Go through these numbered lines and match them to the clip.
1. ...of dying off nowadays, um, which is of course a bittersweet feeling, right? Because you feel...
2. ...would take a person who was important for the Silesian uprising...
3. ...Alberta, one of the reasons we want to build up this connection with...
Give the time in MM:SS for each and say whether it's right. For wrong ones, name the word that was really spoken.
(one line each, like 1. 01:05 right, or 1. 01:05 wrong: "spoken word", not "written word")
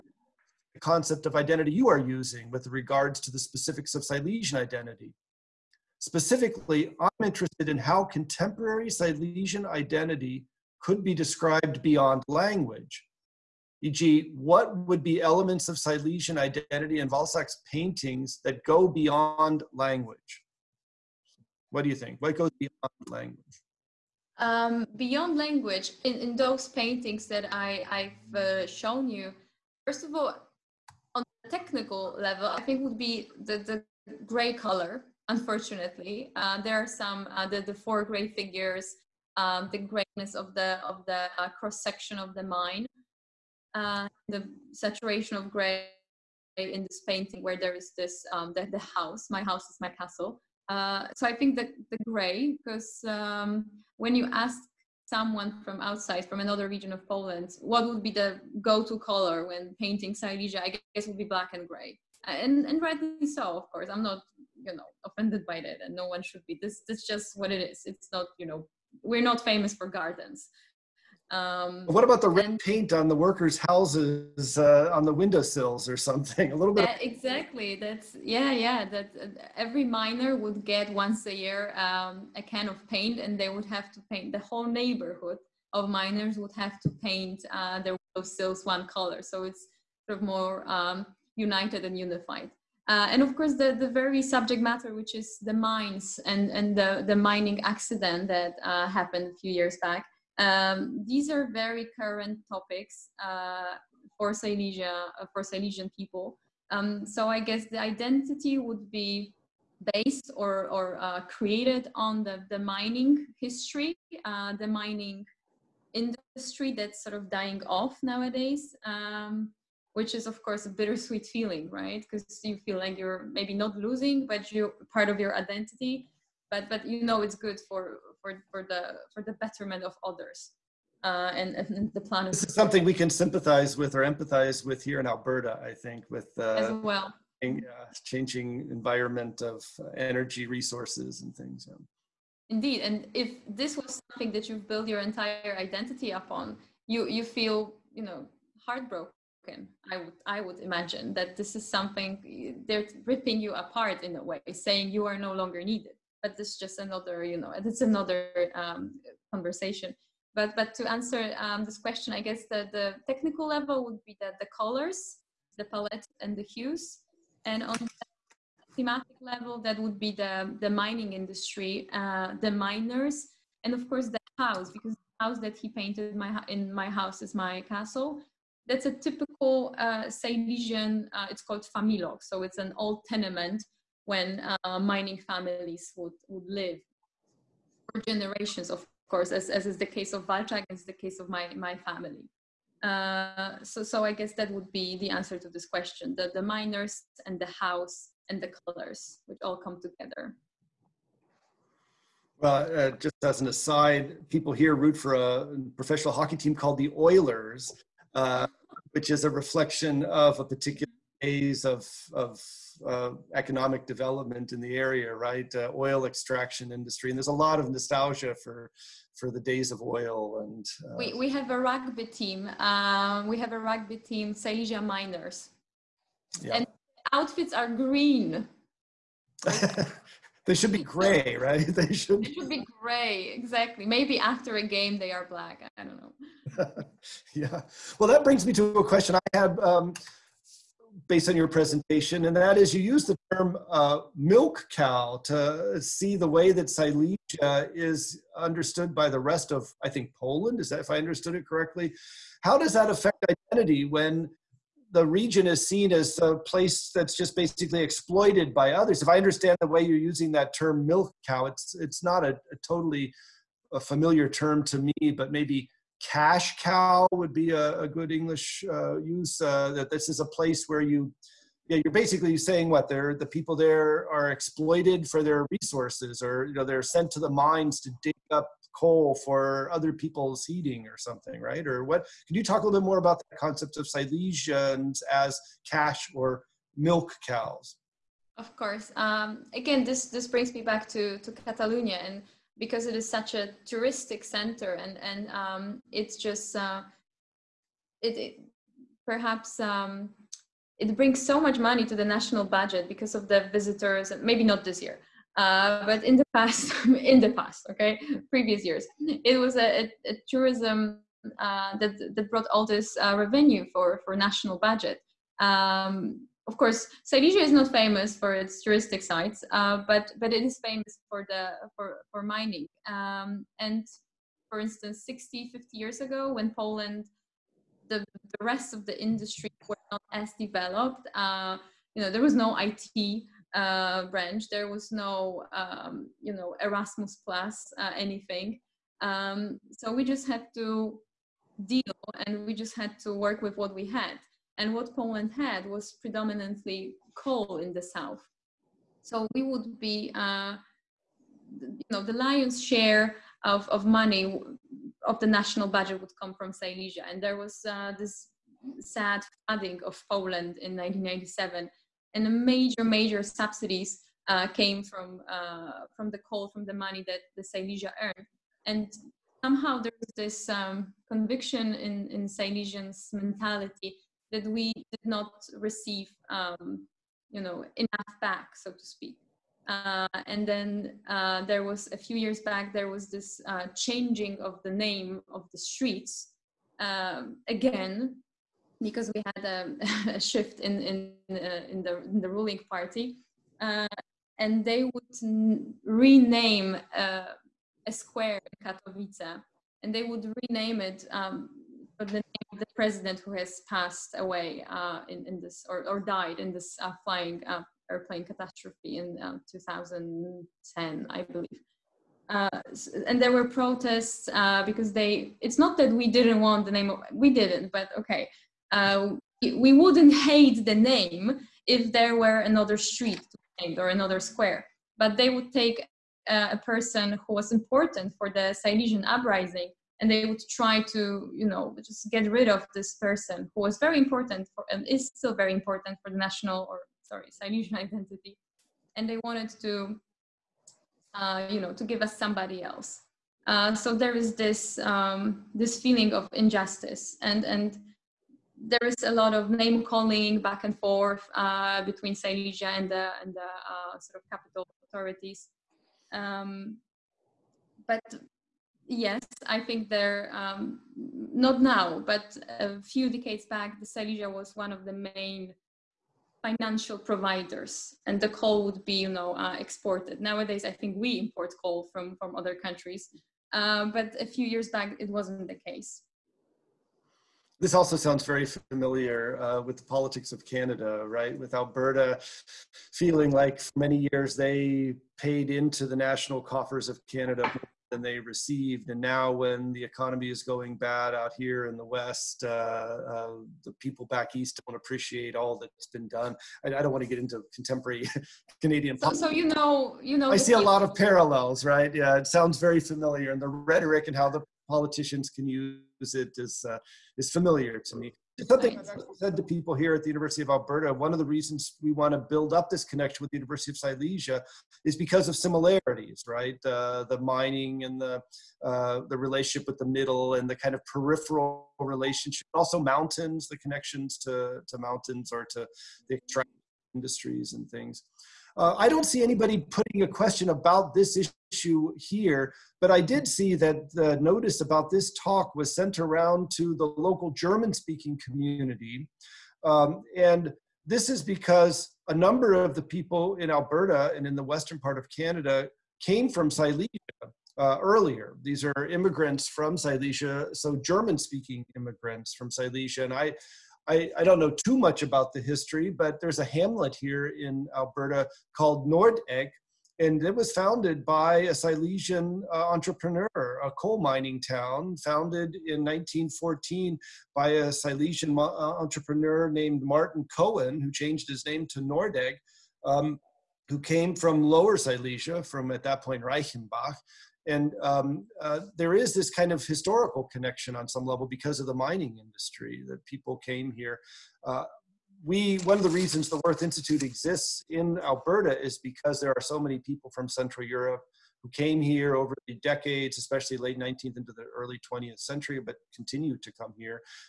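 1. 01:57 right
2. 07:05 right
3. 08:30 right.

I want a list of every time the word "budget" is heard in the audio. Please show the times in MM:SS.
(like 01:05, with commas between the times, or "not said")
05:02, 05:14, 05:55.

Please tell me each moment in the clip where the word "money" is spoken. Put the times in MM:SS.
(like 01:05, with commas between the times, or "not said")
05:01, 05:53, 06:06.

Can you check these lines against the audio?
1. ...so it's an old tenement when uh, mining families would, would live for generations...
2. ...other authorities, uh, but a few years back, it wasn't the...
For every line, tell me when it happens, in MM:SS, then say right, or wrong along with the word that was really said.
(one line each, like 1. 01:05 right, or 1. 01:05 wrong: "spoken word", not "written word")
1. 03:02 right
2. 07:52 wrong: "countries", not "authorities".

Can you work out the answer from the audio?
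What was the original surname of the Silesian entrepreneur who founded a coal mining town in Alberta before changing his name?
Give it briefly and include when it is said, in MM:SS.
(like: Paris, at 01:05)
Cohen, at 09:30.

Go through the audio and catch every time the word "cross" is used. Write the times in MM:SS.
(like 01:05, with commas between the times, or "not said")
00:41.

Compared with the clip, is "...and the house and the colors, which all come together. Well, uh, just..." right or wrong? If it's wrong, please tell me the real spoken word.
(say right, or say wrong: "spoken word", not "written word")
right.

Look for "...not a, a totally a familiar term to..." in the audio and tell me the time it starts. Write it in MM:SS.
04:22.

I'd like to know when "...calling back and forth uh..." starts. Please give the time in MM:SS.
07:29.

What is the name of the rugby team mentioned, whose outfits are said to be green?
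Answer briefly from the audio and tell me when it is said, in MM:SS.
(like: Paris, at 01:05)
Silesia Miners, at 03:44.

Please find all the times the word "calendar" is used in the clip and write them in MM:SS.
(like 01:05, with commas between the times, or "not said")
not said.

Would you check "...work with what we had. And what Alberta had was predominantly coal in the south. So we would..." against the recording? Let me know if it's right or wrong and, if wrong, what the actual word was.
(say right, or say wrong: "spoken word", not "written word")
wrong: "Poland", not "Alberta".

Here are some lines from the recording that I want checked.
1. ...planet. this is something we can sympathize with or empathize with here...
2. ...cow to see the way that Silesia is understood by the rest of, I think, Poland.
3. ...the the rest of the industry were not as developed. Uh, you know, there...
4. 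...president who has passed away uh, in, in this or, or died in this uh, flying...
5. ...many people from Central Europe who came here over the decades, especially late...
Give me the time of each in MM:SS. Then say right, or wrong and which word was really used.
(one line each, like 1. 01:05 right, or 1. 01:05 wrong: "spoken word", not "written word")
1. 02:11 right
2. 04:04 right
3. 05:27 right
4. 06:42 right
5. 09:49 right.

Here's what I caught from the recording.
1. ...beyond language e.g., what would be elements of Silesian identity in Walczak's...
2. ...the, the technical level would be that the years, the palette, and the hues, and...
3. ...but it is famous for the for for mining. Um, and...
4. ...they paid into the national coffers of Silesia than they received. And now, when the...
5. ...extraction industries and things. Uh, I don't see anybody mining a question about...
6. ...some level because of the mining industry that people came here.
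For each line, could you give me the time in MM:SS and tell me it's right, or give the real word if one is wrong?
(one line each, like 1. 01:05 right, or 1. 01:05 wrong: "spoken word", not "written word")
1. 00:11 right
2. 02:42 wrong: "colors", not "years"
3. 05:20 right
4. 08:04 wrong: "Canada", not "Silesia"
5. 08:46 wrong: "putting", not "mining"
6. 09:40 right.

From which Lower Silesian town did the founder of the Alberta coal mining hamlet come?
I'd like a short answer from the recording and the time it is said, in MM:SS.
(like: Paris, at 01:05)
Reichenbach, at 09:36.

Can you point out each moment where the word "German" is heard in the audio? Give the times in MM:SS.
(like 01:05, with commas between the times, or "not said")
08:57, 09:10.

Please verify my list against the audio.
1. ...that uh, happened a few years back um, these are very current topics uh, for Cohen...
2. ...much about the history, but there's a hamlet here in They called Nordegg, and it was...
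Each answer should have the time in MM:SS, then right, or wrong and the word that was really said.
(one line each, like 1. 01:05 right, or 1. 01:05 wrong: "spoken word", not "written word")
1. 01:38 wrong: "Silesia", not "Cohen"
2. 09:14 wrong: "Alberta", not "They".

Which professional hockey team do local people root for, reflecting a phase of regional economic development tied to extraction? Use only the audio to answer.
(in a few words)
Oilers.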